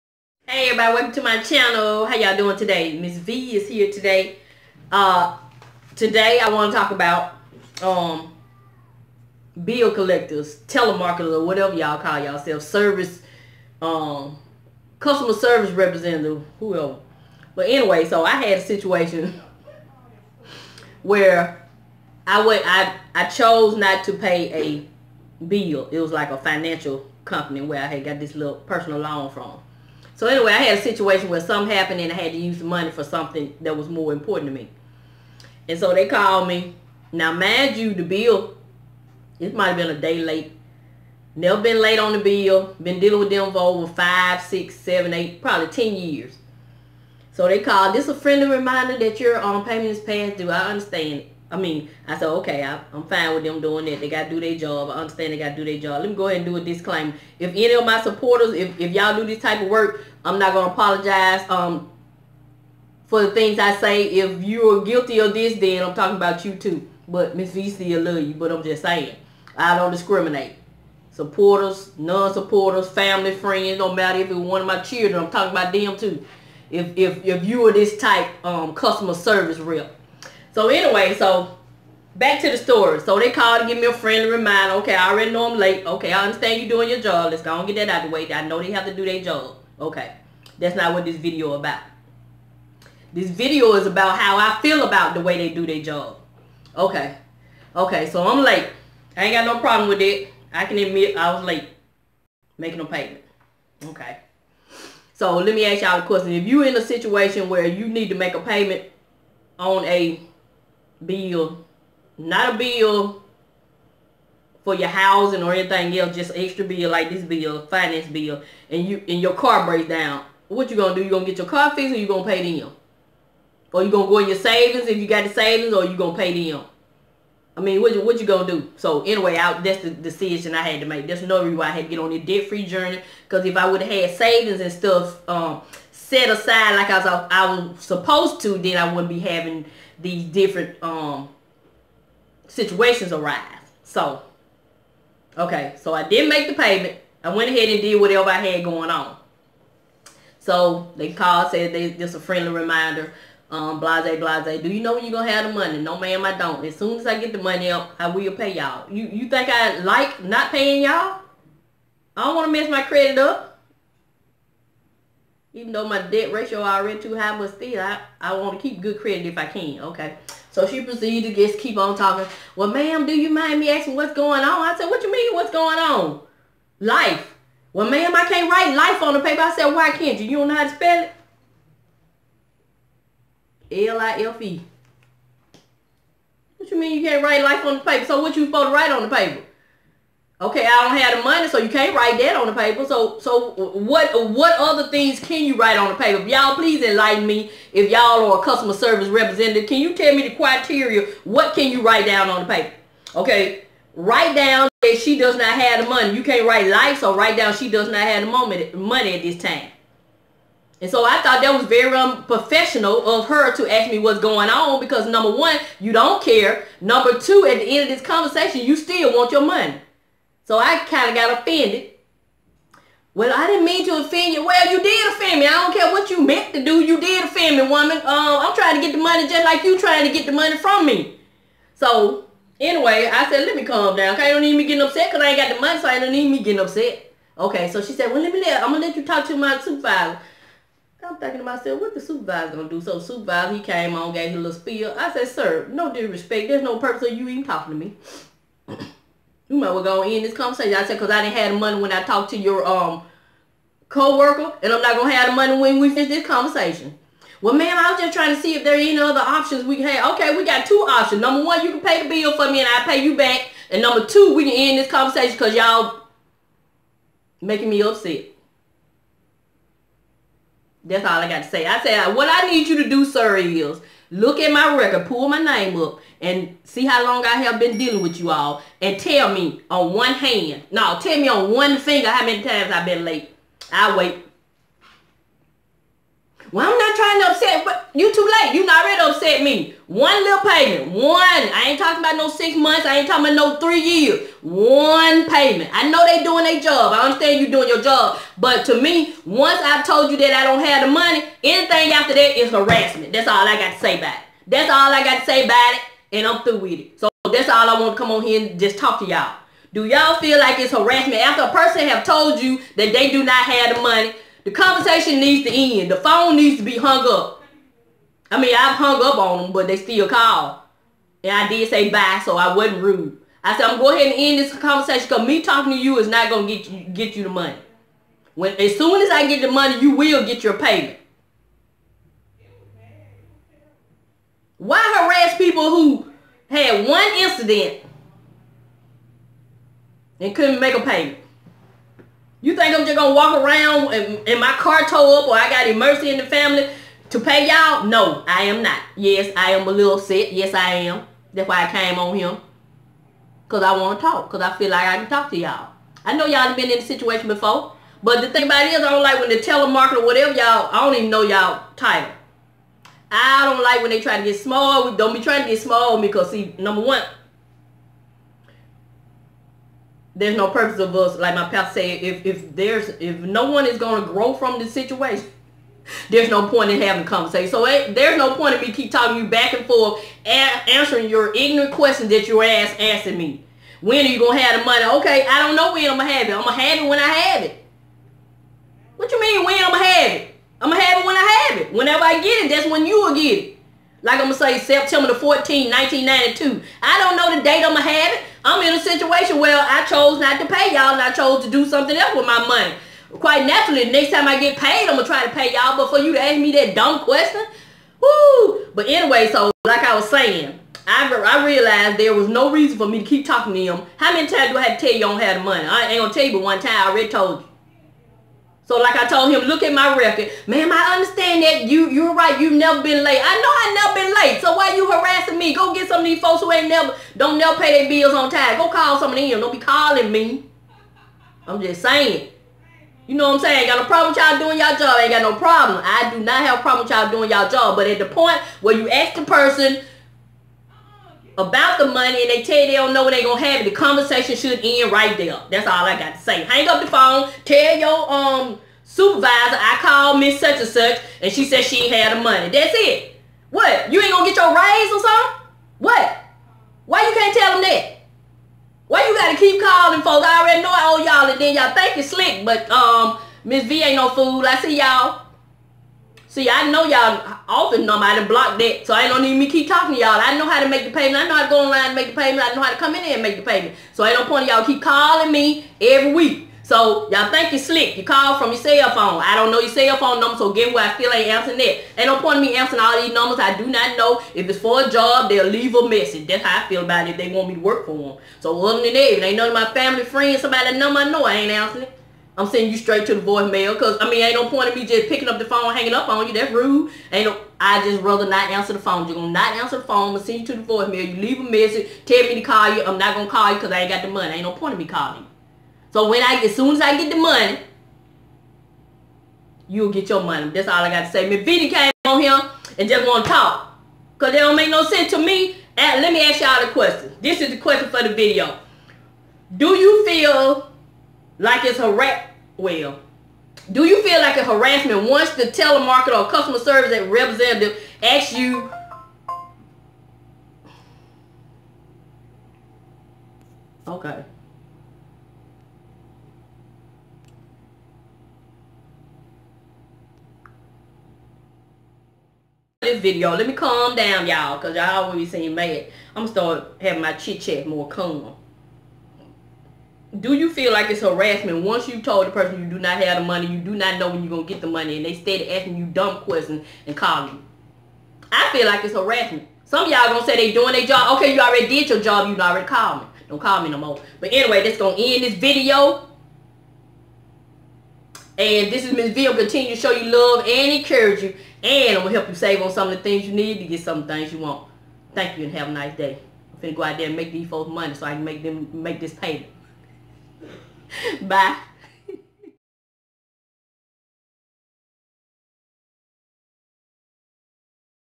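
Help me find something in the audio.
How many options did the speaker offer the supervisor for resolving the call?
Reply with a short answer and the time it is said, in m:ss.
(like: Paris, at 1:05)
2, at 4:20.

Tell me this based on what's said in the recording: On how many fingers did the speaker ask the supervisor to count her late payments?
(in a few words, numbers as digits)
1.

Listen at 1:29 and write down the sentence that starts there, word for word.
Okay, that's not what this video about.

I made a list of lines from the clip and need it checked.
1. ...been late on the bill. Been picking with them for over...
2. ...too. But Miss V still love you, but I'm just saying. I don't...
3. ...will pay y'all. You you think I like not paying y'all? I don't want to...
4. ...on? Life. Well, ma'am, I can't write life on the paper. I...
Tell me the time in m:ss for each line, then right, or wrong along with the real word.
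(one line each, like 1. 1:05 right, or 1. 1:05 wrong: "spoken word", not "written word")
1. 0:41 wrong: "dealing", not "picking"
2. 1:06 right
3. 2:38 right
4. 2:55 right.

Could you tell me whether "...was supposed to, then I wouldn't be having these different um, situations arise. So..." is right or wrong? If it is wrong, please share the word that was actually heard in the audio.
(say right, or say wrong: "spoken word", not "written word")
right.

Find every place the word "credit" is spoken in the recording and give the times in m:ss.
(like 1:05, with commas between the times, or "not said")
2:42, 2:49.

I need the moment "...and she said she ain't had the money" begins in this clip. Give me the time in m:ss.
7:31.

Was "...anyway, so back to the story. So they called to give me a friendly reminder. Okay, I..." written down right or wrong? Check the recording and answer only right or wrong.
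right.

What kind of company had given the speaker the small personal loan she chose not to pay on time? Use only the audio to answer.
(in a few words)
Financial company.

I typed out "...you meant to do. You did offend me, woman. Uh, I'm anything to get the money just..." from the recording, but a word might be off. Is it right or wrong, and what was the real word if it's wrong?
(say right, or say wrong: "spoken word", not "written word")
wrong: "trying", not "anything".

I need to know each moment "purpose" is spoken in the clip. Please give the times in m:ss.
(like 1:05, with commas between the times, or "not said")
4:06, 6:10.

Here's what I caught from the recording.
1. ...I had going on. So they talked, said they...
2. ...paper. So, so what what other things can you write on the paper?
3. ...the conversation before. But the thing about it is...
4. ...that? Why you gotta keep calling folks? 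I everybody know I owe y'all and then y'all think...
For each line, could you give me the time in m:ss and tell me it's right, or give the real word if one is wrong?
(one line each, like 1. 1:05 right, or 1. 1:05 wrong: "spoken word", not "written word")
1. 2:28 wrong: "called", not "talked"
2. 3:12 right
3. 5:56 wrong: "situation", not "conversation"
4. 7:37 wrong: "already", not "everybody".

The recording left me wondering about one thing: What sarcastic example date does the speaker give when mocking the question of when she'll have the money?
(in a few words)
September 14, 1992.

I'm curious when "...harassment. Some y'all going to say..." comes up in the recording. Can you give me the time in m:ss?
9:18.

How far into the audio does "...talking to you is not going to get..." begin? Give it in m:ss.
5:25.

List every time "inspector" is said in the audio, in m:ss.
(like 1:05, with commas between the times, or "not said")
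not said.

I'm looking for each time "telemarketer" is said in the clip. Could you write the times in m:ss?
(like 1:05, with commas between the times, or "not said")
0:10, 5:59, 8:45.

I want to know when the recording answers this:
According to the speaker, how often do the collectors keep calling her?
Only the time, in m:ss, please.
7:55.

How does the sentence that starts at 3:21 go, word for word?
What can you write down on the paper?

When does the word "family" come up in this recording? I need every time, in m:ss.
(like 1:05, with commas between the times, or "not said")
1:12, 5:46, 8:09.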